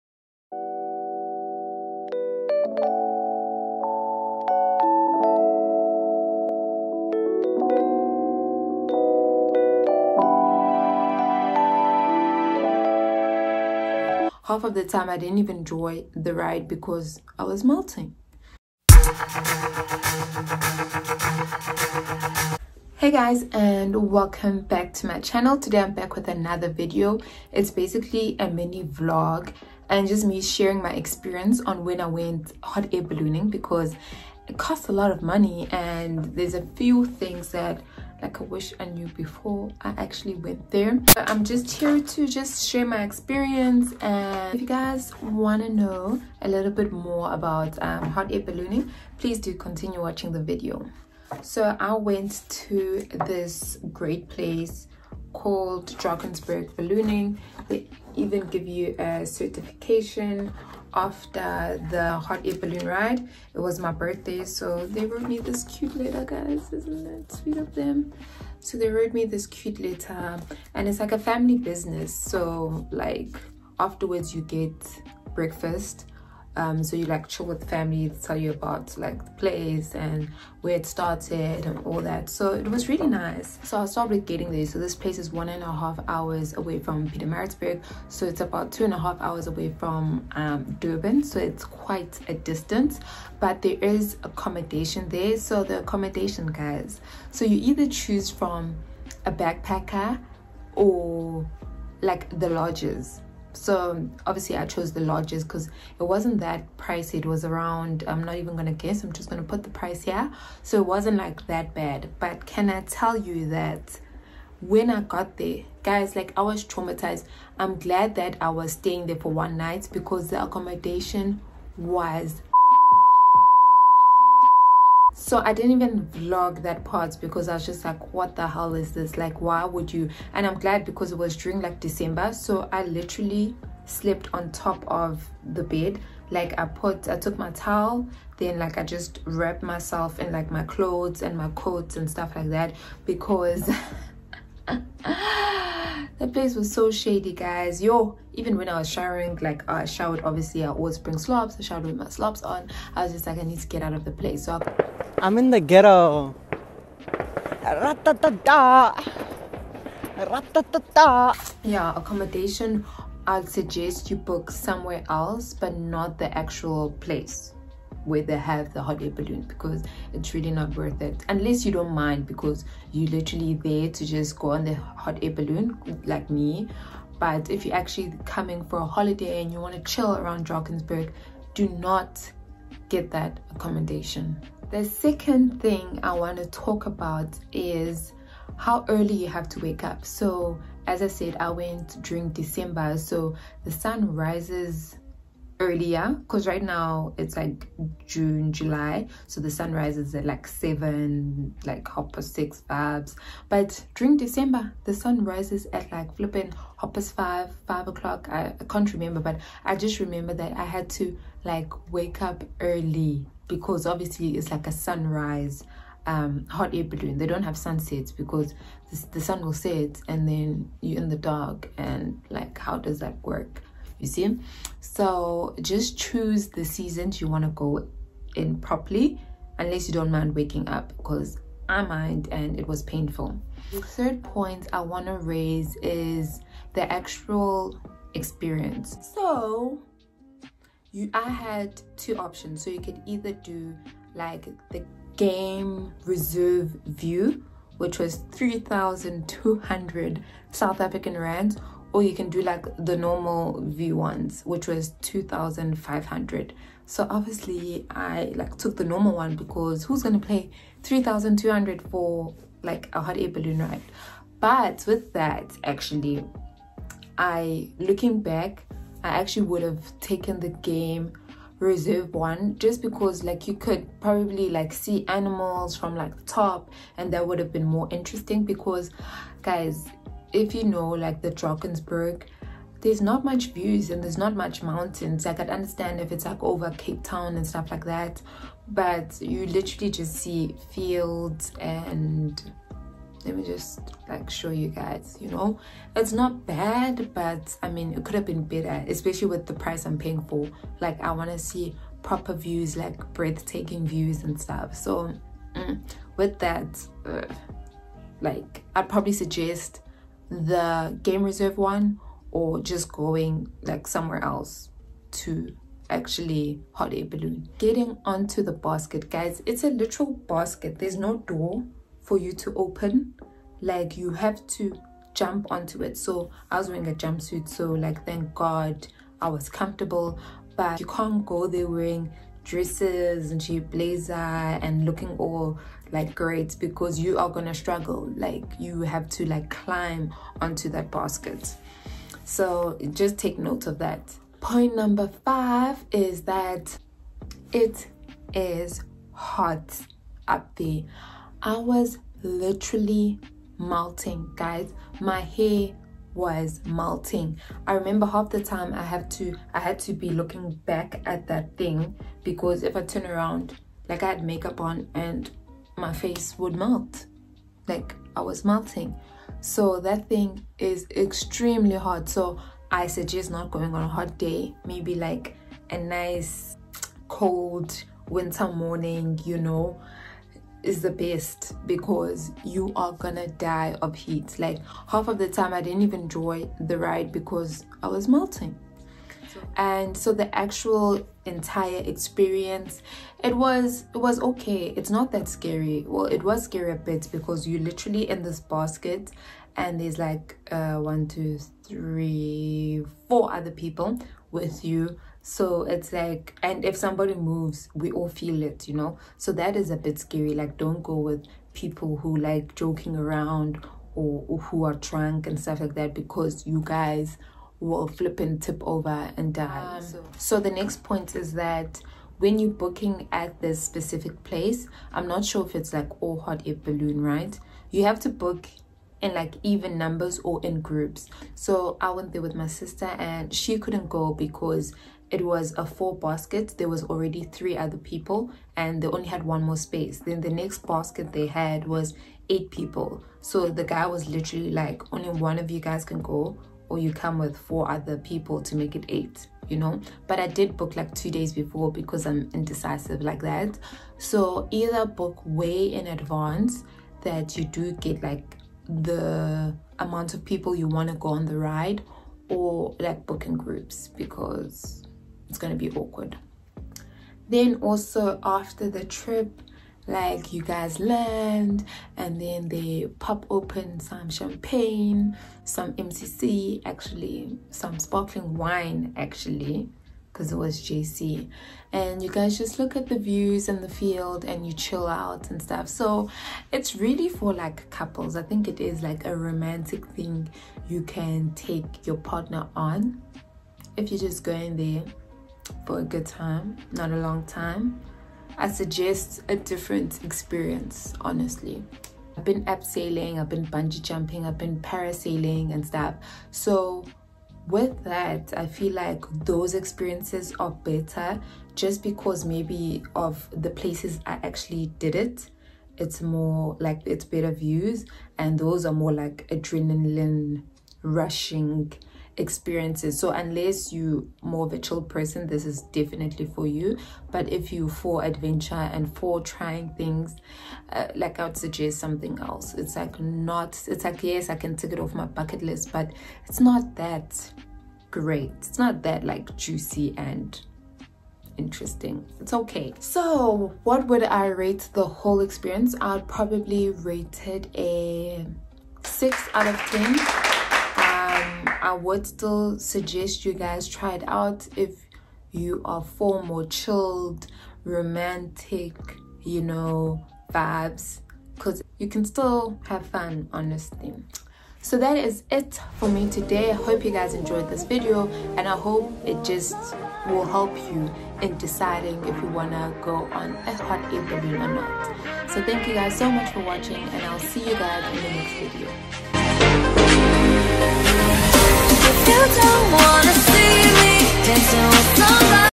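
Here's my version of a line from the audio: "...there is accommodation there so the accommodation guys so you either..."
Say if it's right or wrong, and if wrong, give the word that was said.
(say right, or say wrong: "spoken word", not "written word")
right.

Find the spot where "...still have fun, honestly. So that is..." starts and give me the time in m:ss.
9:22.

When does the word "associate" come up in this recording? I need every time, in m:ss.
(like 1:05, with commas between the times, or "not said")
not said.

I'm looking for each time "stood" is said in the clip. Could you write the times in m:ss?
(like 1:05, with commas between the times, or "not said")
not said.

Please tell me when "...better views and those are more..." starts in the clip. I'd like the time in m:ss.
8:37.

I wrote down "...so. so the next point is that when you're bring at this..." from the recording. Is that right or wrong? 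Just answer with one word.
wrong.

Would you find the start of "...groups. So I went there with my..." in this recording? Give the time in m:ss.
7:10.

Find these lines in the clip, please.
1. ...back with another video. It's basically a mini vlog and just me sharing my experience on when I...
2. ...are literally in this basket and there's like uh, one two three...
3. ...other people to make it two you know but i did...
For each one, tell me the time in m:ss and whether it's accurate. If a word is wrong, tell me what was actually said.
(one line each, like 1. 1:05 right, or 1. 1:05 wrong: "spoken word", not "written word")
1. 0:25 right
2. 6:37 right
3. 7:27 wrong: "eight", not "two".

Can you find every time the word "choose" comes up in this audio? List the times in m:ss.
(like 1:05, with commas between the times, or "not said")
1:37, 3:45.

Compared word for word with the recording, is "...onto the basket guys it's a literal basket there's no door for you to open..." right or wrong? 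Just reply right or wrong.
right.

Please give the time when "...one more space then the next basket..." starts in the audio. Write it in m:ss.
7:19.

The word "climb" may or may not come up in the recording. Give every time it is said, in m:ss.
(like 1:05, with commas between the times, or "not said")
5:39.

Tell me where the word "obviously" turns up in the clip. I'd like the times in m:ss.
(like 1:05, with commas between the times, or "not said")
1:44, 2:30, 3:33, 4:17.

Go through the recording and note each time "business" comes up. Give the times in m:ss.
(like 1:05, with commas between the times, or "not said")
1:11.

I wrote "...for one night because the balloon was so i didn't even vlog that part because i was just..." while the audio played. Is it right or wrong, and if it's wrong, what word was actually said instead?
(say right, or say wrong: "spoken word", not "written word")
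wrong: "accommodation", not "balloon".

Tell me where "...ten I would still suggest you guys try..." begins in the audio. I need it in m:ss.
9:09.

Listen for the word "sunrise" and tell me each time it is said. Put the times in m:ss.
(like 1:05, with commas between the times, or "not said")
3:34.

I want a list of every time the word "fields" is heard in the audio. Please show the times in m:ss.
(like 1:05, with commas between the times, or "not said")
4:50, 8:03.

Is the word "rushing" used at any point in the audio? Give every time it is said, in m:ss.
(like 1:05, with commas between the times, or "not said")
8:40.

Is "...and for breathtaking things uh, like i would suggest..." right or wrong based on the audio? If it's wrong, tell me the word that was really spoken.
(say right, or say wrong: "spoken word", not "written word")
wrong: "trying", not "breathtaking".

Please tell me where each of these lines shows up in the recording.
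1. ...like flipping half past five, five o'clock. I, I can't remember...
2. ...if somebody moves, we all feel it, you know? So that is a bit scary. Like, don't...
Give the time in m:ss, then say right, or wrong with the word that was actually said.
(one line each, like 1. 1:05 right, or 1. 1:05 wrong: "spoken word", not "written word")
1. 3:25 right
2. 6:46 right.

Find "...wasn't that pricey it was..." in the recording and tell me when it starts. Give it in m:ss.
1:46.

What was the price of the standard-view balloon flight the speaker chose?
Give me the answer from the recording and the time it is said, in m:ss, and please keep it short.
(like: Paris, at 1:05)
2500 rand, at 4:15.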